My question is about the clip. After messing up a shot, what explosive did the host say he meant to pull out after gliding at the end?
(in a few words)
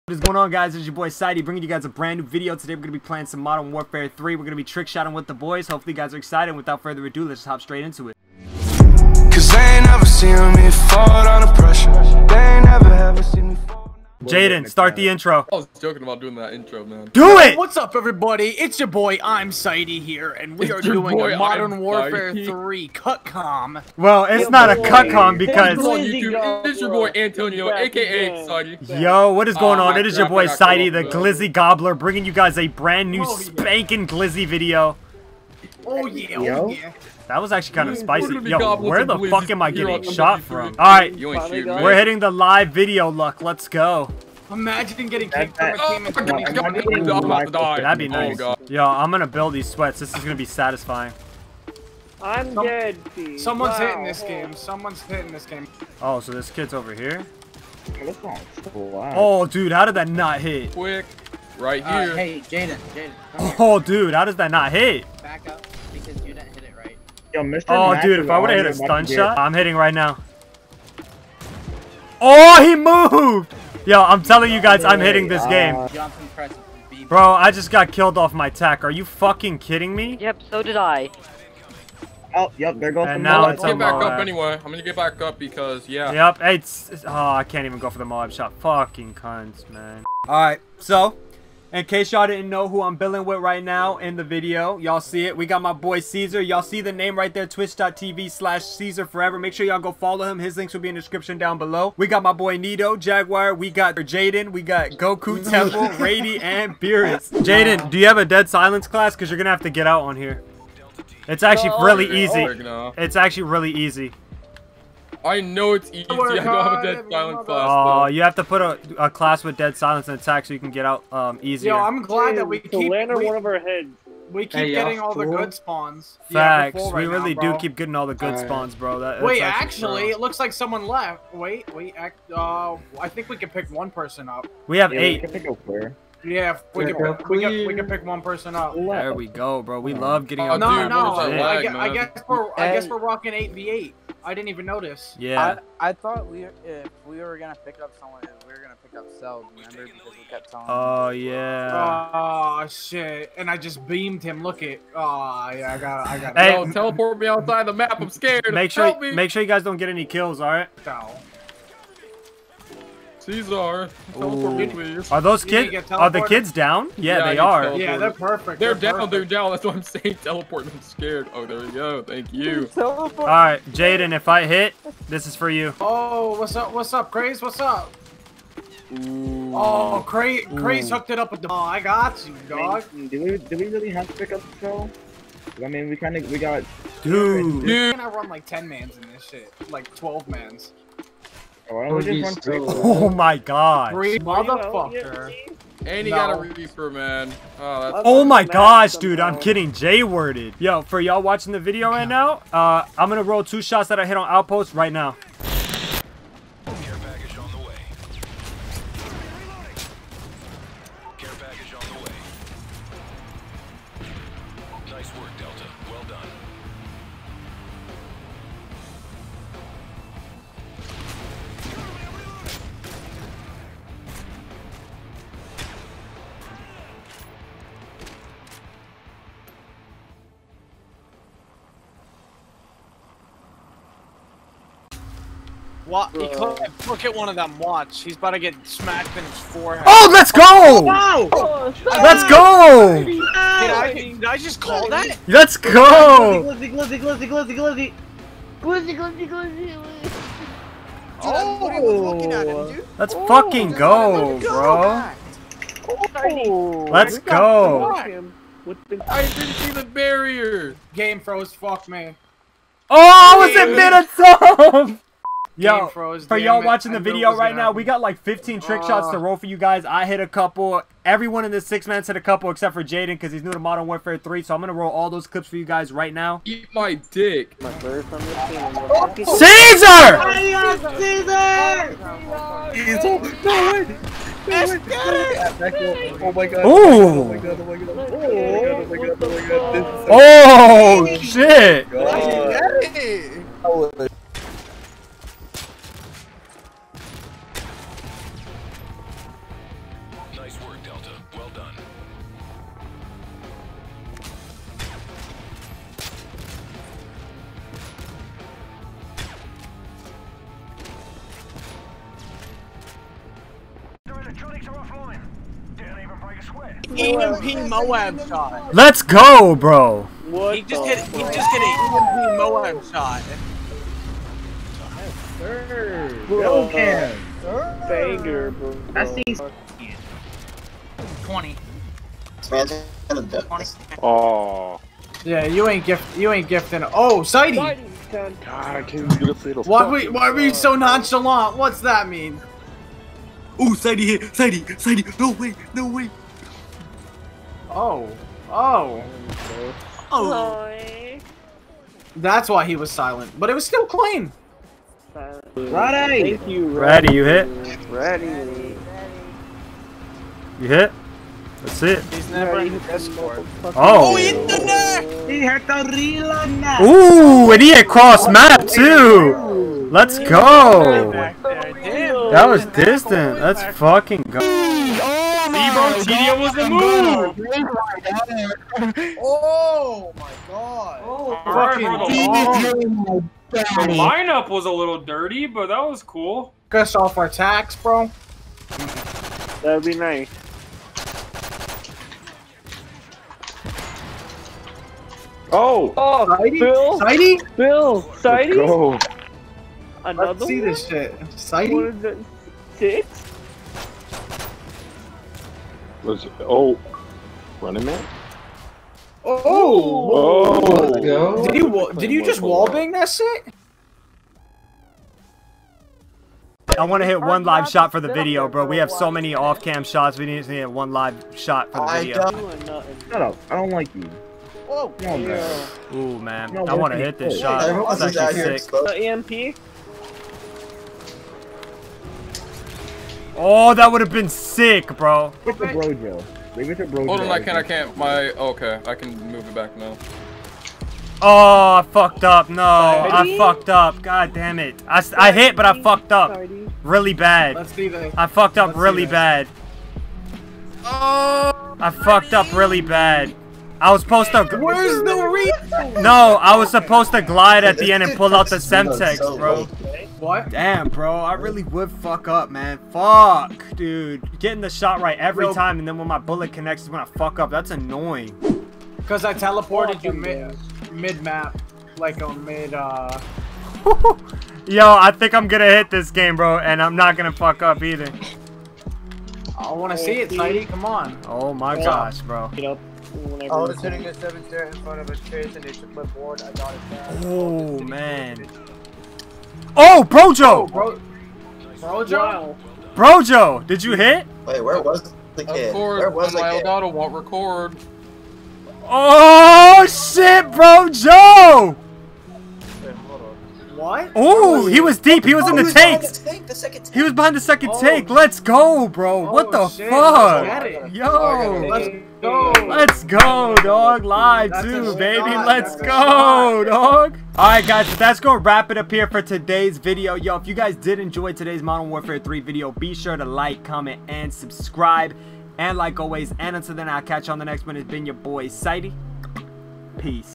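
Semtex.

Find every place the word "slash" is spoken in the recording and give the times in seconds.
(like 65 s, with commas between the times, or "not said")
98 s.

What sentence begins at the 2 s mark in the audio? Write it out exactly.
Today we're going to be playing some Modern Warfare 3.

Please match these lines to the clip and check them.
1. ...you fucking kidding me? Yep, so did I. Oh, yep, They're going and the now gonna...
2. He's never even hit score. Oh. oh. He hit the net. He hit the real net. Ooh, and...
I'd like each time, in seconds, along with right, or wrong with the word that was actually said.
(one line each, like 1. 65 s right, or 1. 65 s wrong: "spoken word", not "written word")
1. 78 s right
2. 362 s right.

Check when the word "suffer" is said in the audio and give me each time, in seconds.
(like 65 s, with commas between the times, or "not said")
not said.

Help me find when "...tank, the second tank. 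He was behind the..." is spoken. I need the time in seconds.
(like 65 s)
505 s.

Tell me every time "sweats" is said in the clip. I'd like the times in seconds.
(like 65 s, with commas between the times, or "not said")
49 s.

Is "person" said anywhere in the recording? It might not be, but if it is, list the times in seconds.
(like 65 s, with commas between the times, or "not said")
133 s, 138 s.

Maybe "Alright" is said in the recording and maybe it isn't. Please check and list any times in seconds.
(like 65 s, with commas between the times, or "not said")
90 s, 517 s.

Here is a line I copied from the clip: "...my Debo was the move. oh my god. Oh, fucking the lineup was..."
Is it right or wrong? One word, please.
right.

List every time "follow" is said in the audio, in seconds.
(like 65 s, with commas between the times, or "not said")
99 s.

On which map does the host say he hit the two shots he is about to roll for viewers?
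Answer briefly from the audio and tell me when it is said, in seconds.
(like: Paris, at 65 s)
Outpost, at 204 s.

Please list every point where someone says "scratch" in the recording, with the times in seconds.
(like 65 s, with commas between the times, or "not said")
not said.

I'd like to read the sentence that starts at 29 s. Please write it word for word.
It is your boy, Sightey, the Glizzy Gobbler, bringing you guys a brand new oh, spanking Glizzy video.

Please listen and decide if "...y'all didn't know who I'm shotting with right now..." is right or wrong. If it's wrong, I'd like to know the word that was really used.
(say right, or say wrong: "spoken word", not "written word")
wrong: "billing", not "shotting".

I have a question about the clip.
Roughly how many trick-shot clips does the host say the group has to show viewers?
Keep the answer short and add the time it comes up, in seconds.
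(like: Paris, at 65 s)
15, at 268 s.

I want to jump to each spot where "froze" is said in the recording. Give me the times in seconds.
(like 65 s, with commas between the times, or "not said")
261 s, 265 s.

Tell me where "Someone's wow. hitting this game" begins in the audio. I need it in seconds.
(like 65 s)
53 s.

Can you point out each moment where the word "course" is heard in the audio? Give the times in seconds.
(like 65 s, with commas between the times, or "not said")
495 s.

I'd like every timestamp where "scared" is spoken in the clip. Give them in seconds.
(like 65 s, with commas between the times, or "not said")
158 s, 170 s.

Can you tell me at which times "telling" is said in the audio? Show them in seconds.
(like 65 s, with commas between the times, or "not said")
74 s, 150 s.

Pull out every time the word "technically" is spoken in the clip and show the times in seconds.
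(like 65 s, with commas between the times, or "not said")
not said.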